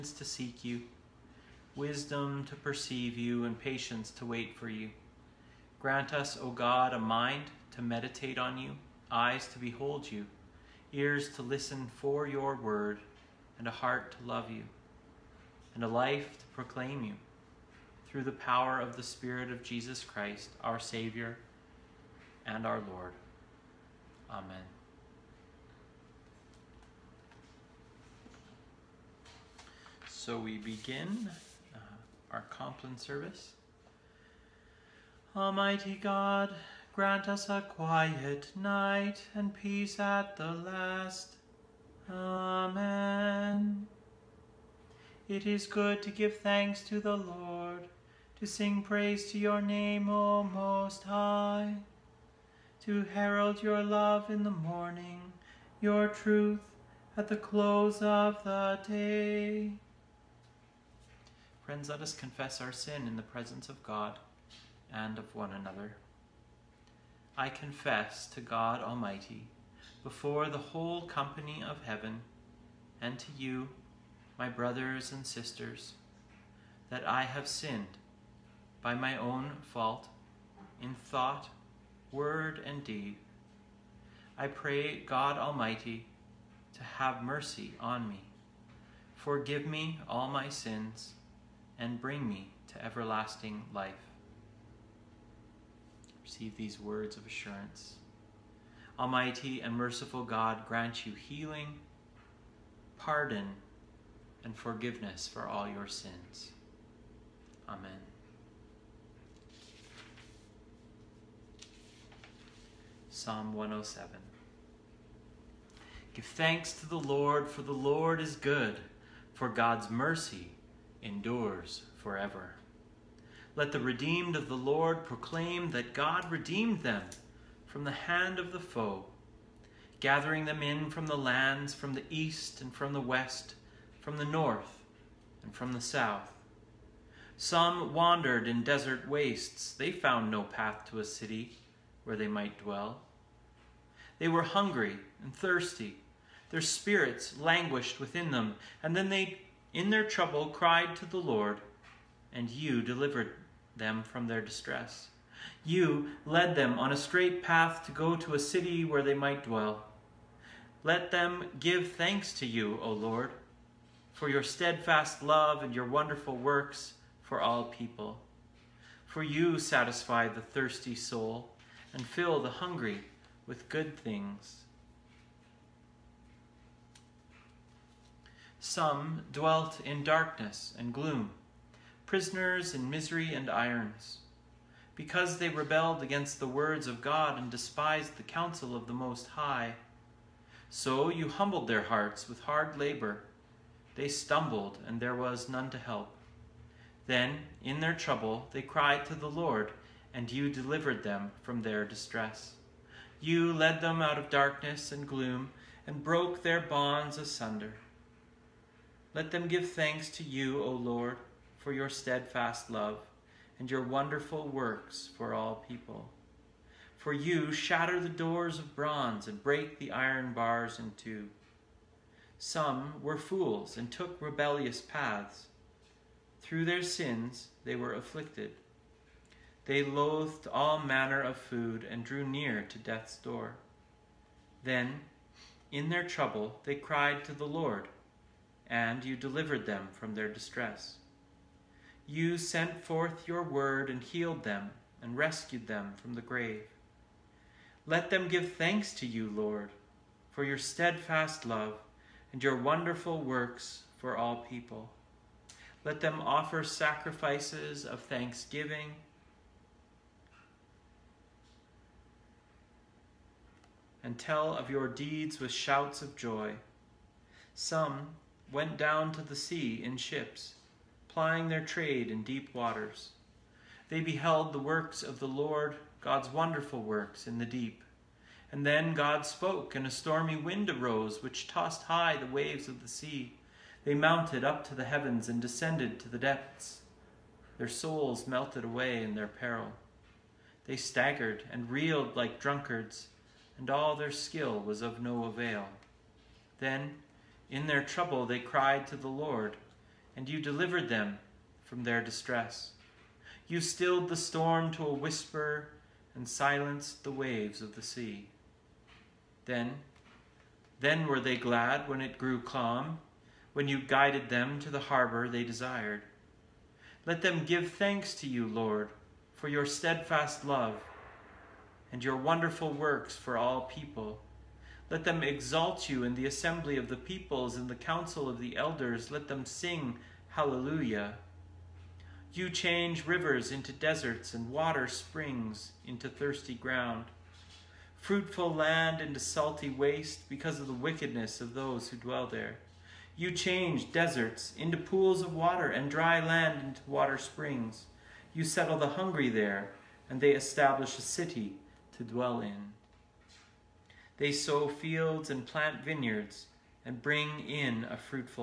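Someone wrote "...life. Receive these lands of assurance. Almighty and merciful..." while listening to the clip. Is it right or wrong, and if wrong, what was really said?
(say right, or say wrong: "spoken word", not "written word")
wrong: "words", not "lands".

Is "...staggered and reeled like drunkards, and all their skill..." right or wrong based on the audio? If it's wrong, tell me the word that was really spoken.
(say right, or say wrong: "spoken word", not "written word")
right.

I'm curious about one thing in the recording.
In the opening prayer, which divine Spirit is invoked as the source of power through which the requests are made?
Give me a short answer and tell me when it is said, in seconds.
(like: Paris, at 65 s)
Spirit of Jesus Christ, at 19 s.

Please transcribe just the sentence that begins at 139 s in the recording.
They found no path to a city where they might dwell.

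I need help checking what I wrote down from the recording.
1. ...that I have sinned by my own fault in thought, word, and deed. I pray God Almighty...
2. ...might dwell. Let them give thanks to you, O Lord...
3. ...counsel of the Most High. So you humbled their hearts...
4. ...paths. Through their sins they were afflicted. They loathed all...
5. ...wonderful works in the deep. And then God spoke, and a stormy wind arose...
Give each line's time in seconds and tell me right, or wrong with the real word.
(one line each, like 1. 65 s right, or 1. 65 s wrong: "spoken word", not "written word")
1. 76 s right
2. 159 s right
3. 188 s right
4. 224 s right
5. 276 s right.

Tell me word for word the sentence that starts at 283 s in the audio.
They mounted up to the heavens and descended to the depths.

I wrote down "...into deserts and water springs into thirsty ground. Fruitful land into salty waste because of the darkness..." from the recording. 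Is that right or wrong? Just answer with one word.
wrong.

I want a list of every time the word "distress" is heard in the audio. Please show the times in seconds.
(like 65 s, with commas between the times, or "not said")
154 s, 201 s, 240 s, 302 s.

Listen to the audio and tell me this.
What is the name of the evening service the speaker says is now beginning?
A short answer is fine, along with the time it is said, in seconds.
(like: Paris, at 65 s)
Compline, at 32 s.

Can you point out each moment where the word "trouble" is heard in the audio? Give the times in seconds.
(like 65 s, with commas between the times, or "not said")
150 s, 197 s, 236 s, 297 s.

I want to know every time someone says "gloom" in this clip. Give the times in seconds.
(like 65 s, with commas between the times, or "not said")
180 s, 205 s.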